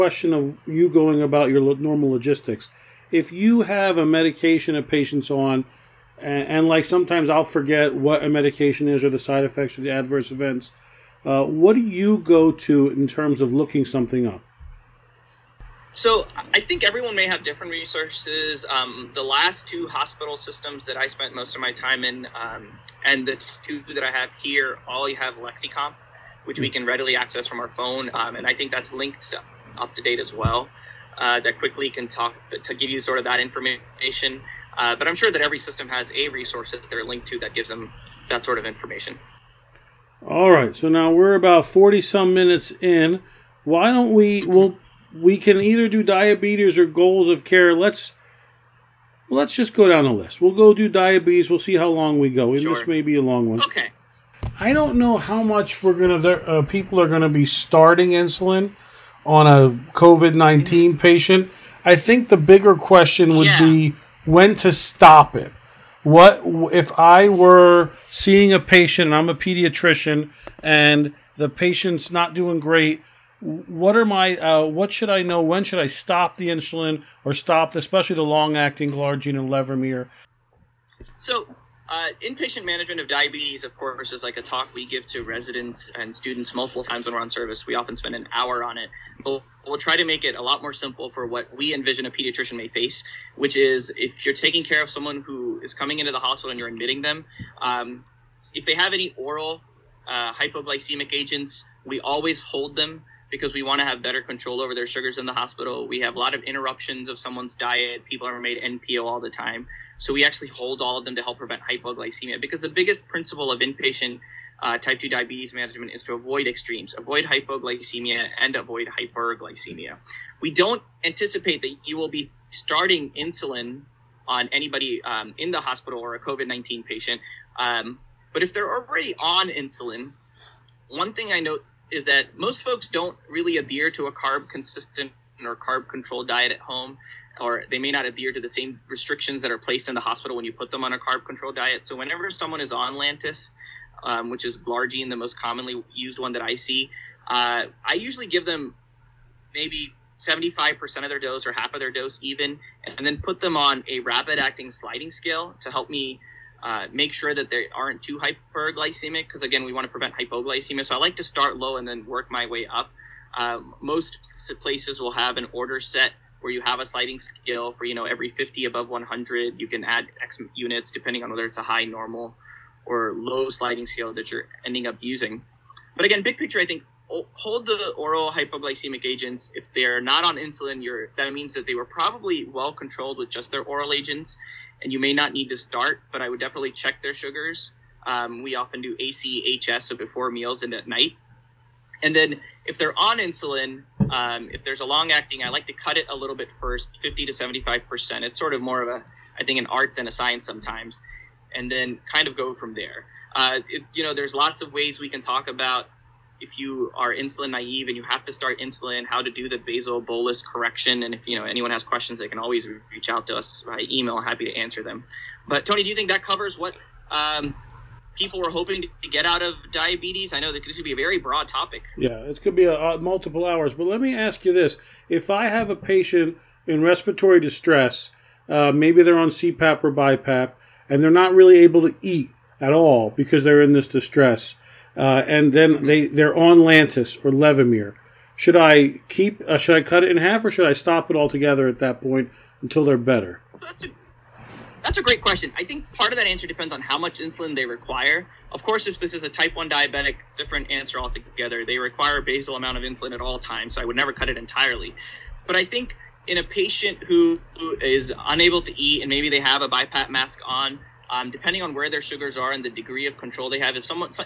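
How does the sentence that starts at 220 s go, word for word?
I know that this would be a very broad topic.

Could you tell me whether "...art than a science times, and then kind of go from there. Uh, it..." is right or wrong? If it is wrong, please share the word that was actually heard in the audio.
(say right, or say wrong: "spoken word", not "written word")
wrong: "sometimes", not "times".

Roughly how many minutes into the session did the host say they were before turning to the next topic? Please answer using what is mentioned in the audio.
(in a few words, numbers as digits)
40.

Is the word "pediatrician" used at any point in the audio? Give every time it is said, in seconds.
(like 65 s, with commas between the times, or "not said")
69 s, 92 s.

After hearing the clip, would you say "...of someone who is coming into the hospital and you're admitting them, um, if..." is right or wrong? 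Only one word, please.
right.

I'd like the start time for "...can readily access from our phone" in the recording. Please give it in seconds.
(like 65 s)
26 s.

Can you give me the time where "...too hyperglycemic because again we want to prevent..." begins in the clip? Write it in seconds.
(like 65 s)
158 s.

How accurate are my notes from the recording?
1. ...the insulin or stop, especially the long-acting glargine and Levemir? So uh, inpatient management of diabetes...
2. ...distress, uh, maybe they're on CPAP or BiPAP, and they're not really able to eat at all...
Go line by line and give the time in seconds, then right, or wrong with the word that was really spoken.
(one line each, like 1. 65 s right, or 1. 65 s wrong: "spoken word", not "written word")
1. 76 s right
2. 227 s right.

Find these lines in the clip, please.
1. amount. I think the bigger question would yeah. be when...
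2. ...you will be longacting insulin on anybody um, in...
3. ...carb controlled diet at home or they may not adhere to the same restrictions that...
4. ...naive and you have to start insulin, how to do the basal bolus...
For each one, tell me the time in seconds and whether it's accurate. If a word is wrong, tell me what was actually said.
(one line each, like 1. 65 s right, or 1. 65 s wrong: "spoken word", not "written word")
1. 60 s wrong: "patient", not "amount"
2. 121 s wrong: "starting", not "longacting"
3. 135 s right
4. 207 s right.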